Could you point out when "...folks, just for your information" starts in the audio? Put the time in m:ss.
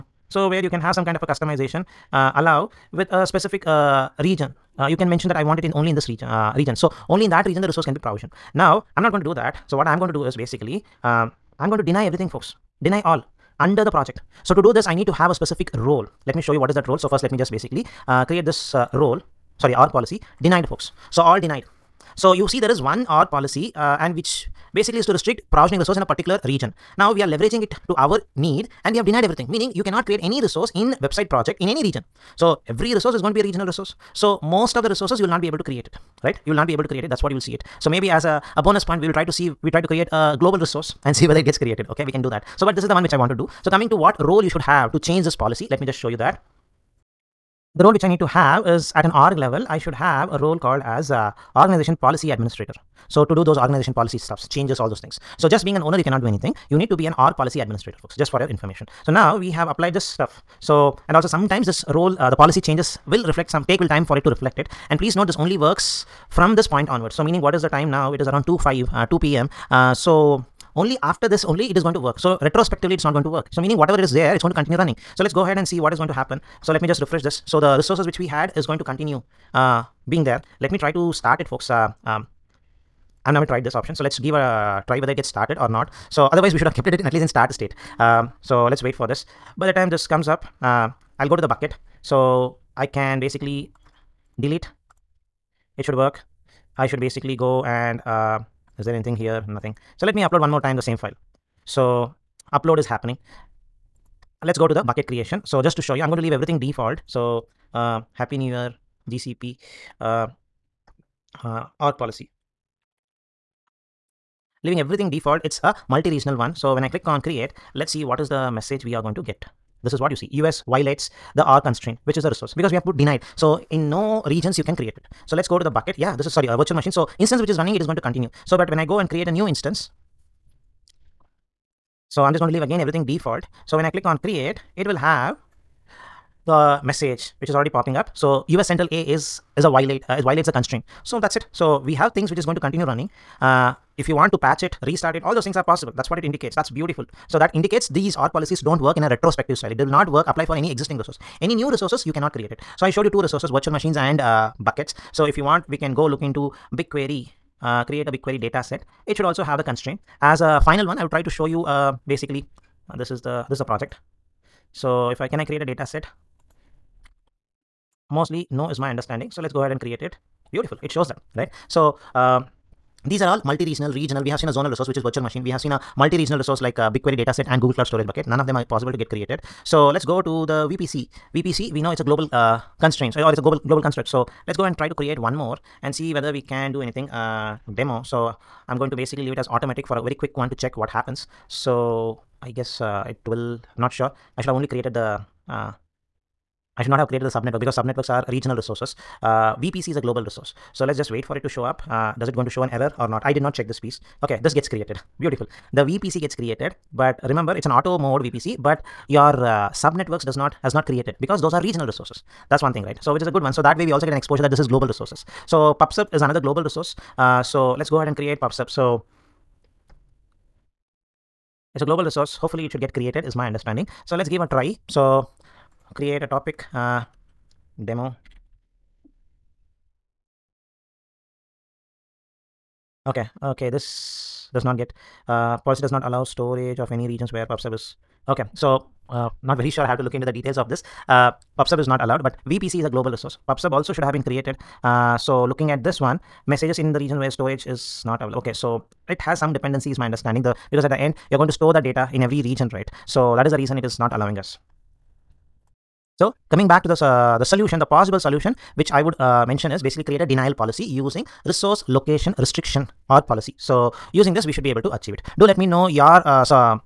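0:58.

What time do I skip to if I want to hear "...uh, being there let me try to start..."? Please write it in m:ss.
1:19.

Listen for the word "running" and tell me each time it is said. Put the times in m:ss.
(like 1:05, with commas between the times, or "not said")
1:14, 2:07, 2:22.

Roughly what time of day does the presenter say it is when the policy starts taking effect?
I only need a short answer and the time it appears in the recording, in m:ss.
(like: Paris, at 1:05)
2 p.m., at 1:09.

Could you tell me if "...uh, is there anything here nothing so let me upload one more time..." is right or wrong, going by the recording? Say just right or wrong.
right.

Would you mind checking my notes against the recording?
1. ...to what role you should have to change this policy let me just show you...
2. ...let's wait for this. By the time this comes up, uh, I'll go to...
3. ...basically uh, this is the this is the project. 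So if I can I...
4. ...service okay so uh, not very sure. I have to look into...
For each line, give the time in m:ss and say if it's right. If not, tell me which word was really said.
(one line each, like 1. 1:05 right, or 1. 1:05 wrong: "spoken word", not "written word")
1. 0:43 right
2. 1:28 right
3. 2:42 right
4. 3:57 right.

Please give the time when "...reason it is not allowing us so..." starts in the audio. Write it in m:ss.
4:13.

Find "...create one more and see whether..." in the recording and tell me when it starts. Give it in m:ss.
3:04.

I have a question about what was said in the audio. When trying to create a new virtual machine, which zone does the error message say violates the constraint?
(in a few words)
US Central A.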